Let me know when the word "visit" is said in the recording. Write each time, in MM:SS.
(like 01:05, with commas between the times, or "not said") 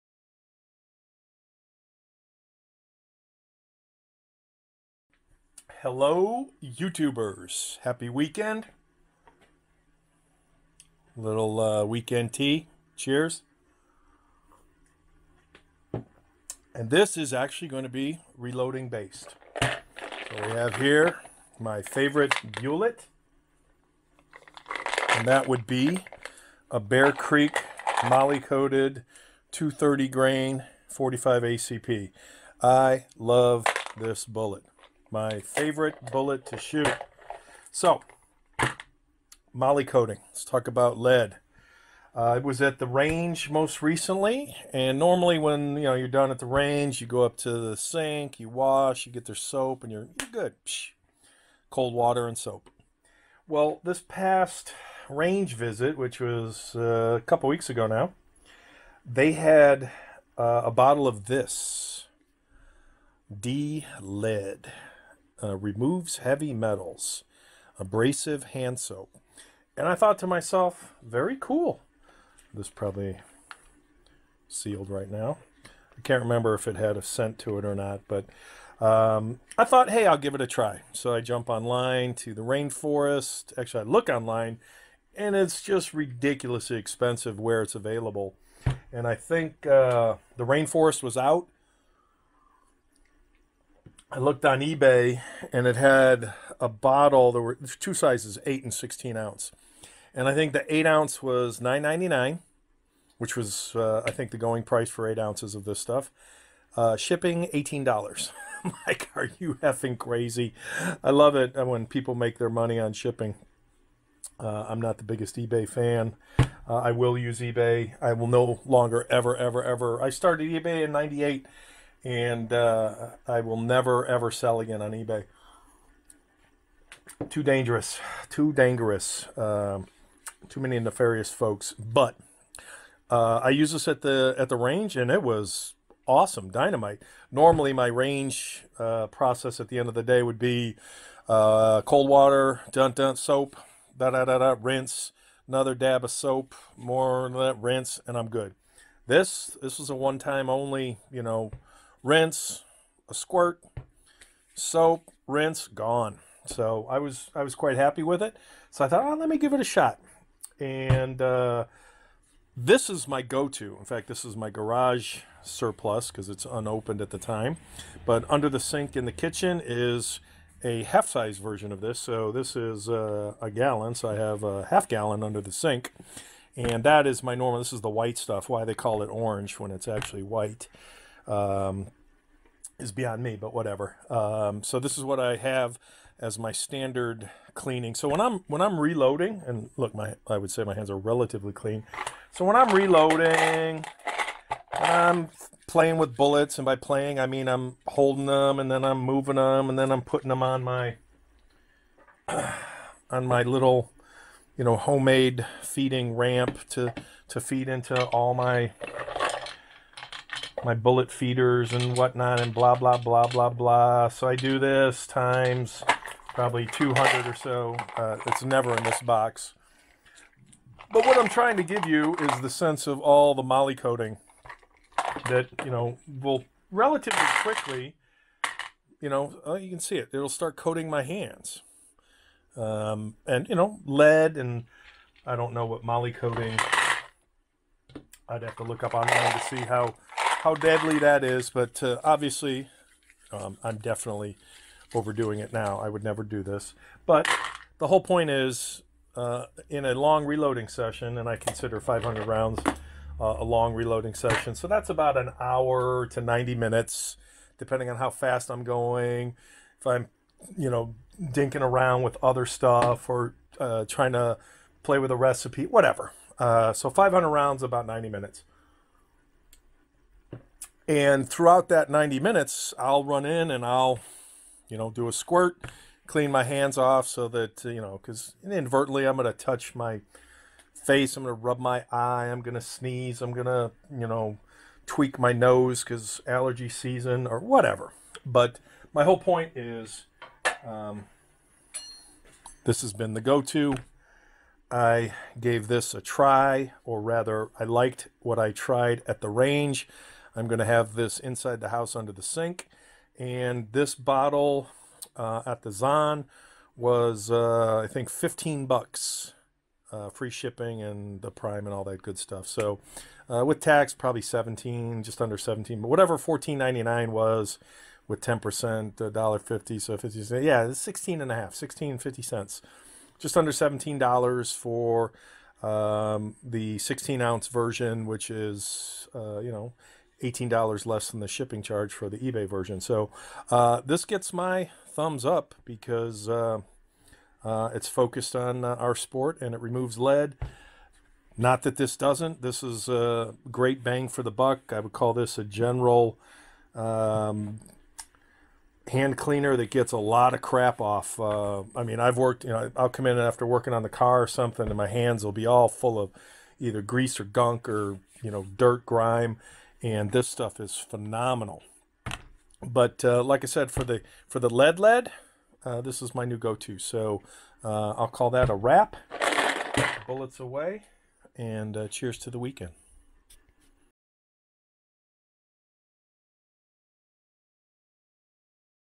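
00:55.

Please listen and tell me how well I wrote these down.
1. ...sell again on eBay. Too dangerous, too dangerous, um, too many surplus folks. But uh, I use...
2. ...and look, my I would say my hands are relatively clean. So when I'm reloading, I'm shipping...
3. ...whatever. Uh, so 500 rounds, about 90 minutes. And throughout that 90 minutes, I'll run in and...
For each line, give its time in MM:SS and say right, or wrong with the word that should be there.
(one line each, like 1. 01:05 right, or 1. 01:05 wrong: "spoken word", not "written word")
1. 02:04 wrong: "nefarious", not "surplus"
2. 03:09 wrong: "playing", not "shipping"
3. 04:25 right.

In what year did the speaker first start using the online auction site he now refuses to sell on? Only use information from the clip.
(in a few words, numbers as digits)
1998.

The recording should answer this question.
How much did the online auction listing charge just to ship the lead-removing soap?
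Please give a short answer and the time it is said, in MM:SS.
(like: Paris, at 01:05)
$18, at 01:46.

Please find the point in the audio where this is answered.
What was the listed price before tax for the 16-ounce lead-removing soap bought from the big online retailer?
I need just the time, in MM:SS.
05:16.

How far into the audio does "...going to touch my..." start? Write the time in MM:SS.
04:39.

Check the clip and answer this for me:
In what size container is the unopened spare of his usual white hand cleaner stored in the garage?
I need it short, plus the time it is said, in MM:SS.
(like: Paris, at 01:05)
a gallon, at 02:53.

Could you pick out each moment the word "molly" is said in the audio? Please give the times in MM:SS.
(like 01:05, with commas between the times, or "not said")
00:28, 00:39, 03:43, 03:55.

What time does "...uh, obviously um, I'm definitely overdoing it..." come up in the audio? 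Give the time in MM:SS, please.
04:01.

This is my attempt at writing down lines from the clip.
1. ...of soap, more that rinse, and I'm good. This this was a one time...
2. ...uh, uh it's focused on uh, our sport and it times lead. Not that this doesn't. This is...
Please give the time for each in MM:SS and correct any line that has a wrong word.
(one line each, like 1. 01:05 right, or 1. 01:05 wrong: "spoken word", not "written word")
1. 02:26 right
2. 05:36 wrong: "removes", not "times".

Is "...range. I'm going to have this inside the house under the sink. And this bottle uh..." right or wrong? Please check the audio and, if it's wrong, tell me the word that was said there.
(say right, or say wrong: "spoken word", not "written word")
right.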